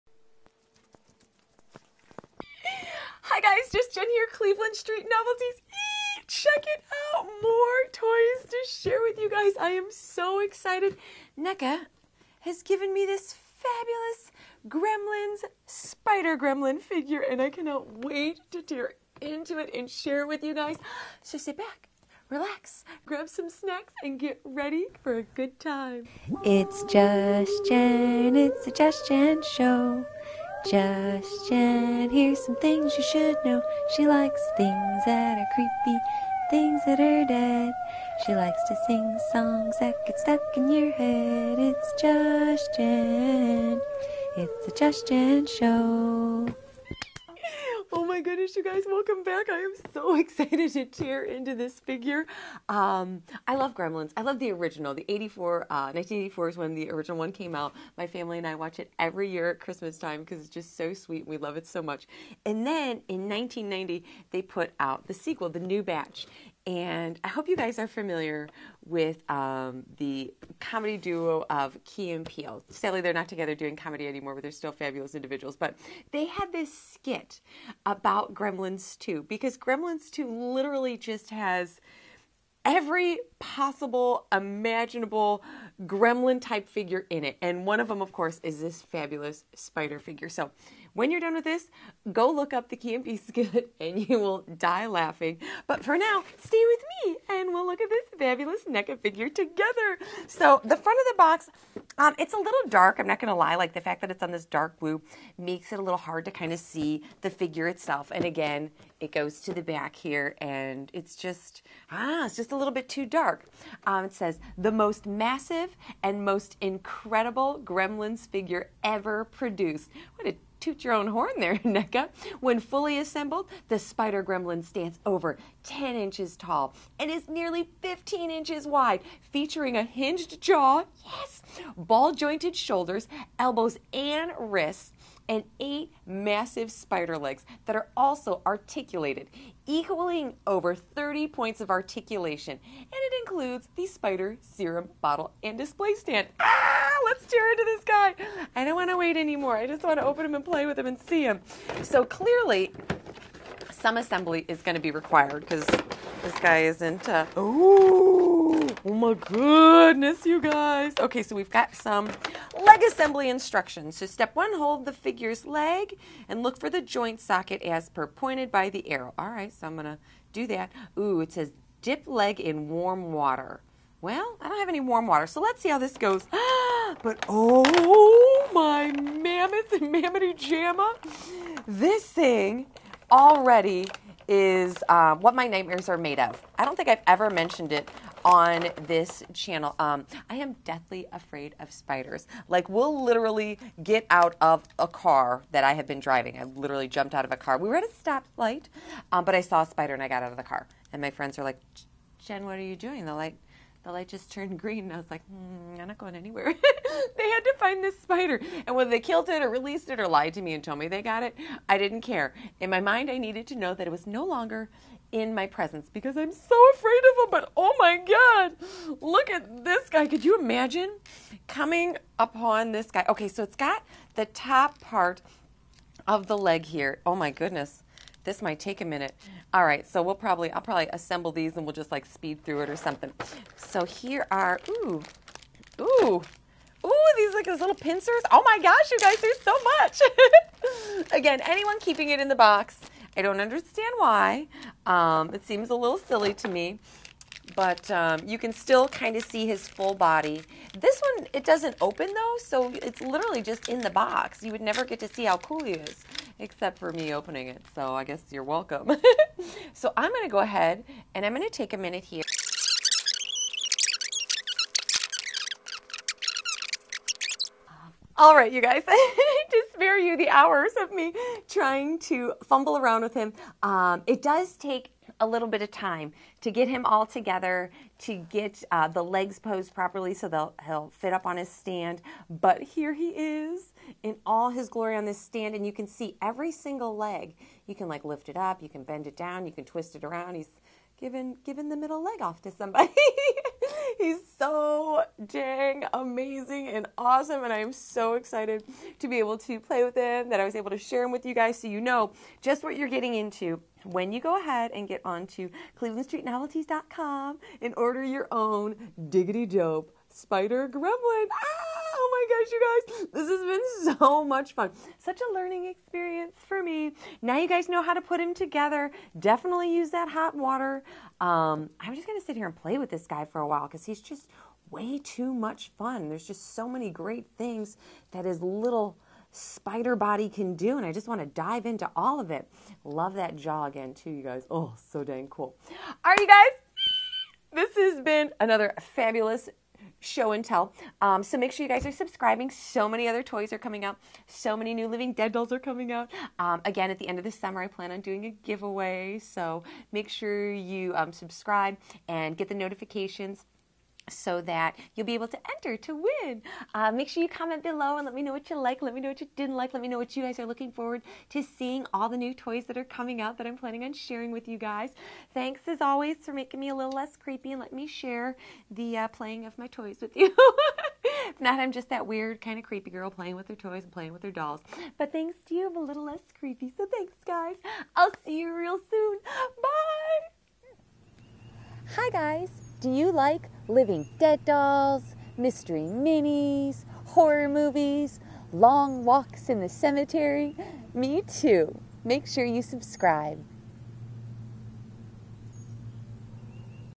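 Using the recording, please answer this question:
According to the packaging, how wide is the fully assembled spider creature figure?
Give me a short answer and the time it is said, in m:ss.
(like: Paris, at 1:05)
15 inches, at 2:07.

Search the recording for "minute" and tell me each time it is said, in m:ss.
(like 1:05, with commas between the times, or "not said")
3:48, 4:21.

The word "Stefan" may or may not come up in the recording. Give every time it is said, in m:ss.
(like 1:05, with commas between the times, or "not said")
not said.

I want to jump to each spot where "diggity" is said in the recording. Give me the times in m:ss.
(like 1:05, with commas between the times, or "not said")
5:09.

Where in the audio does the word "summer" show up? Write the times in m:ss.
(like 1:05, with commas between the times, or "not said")
5:47.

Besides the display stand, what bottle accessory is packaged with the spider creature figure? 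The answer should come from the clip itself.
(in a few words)
spider serum bottle.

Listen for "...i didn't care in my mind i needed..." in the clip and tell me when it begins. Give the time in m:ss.
3:31.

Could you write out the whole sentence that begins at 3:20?
And my friends are like, Jen, what are you doing?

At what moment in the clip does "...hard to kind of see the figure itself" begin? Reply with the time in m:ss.
1:45.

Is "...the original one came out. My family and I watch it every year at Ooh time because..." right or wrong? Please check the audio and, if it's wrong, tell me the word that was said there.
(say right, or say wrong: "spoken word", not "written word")
wrong: "Christmas", not "Ooh".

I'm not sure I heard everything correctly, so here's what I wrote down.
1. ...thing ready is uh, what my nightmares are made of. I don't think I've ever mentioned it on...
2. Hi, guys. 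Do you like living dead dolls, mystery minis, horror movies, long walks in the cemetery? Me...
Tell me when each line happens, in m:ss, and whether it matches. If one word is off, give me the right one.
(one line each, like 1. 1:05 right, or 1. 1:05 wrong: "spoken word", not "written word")
1. 3:02 wrong: "already", not "ready"
2. 6:21 right.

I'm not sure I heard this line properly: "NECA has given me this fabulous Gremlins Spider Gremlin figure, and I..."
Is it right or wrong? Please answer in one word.
right.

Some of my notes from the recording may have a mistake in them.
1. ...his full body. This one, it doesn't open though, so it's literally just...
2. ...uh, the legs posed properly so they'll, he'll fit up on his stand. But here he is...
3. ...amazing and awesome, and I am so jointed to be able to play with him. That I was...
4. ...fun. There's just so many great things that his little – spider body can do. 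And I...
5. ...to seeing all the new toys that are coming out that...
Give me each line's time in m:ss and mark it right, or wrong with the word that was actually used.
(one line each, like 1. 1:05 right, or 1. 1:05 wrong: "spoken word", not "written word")
1. 4:09 right
2. 4:38 right
3. 4:55 wrong: "excited", not "jointed"
4. 5:25 right
5. 6:01 right.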